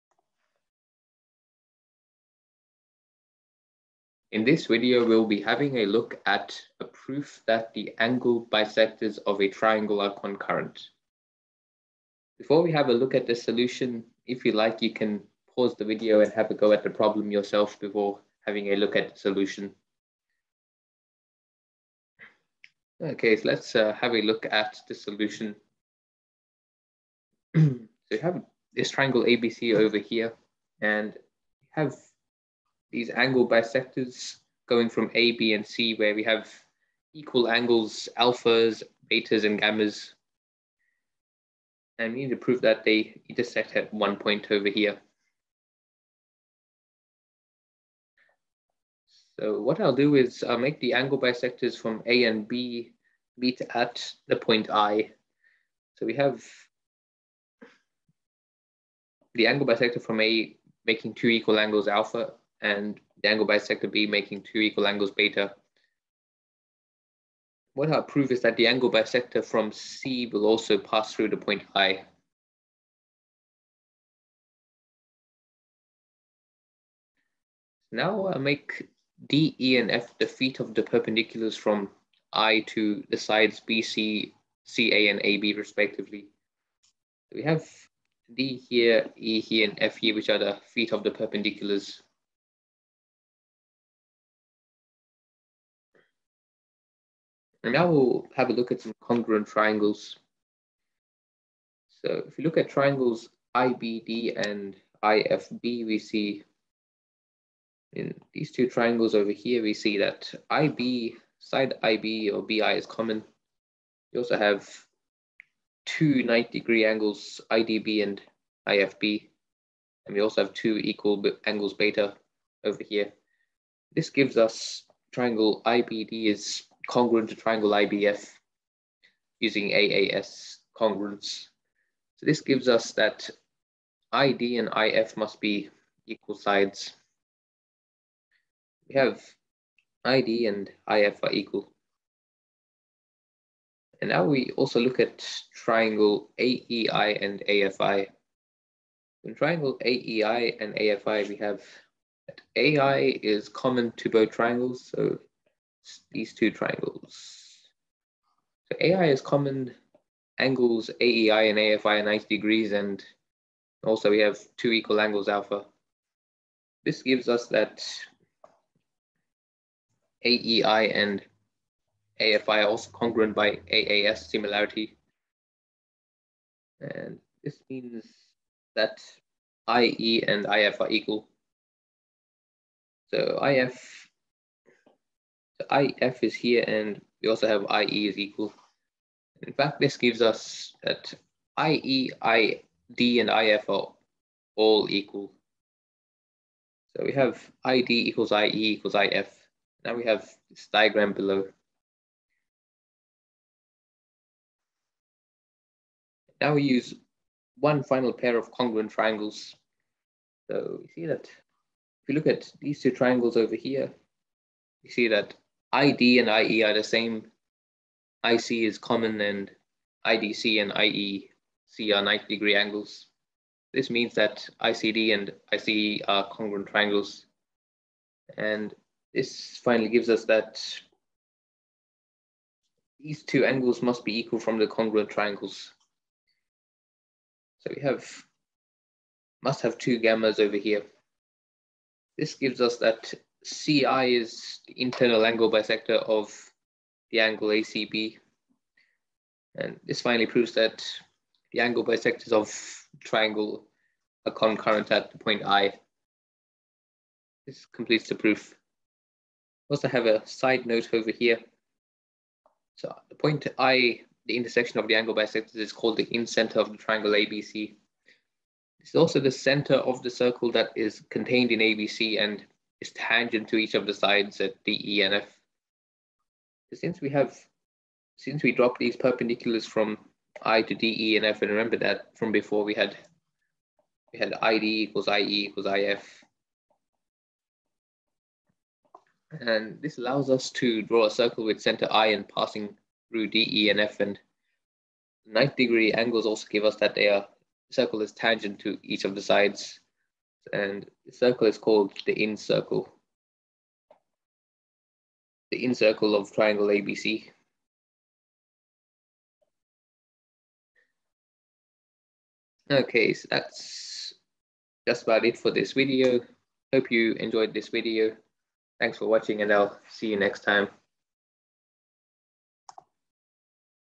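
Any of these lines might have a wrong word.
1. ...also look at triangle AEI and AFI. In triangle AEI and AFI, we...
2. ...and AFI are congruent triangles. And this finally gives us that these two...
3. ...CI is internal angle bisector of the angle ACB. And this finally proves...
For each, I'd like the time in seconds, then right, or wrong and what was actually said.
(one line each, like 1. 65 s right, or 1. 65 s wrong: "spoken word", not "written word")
1. 144 s right
2. 225 s wrong: "ICE", not "AFI"
3. 243 s right.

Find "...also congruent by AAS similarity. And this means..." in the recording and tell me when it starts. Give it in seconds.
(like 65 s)
172 s.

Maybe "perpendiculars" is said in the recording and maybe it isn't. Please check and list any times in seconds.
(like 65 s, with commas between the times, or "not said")
80 s, 91 s, 278 s.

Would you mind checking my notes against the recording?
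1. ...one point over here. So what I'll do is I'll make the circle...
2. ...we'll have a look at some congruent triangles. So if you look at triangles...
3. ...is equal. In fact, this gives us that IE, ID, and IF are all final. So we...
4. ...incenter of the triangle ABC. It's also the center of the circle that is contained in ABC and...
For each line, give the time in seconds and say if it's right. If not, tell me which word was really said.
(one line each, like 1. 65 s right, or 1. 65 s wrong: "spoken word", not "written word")
1. 43 s wrong: "angle", not "circle"
2. 97 s right
3. 188 s wrong: "equal", not "final"
4. 266 s right.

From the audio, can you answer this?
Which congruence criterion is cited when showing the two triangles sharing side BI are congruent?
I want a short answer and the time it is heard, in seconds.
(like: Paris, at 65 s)
AAS congruence, at 129 s.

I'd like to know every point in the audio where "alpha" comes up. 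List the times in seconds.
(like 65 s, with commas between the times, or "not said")
38 s, 61 s, 165 s.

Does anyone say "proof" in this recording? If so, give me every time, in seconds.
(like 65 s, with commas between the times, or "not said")
6 s, 258 s.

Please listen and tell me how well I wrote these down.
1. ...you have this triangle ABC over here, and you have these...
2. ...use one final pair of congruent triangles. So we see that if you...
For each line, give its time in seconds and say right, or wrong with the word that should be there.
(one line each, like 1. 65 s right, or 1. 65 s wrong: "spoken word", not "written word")
1. 28 s right
2. 206 s right.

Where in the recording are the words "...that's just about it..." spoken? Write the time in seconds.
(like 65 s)
313 s.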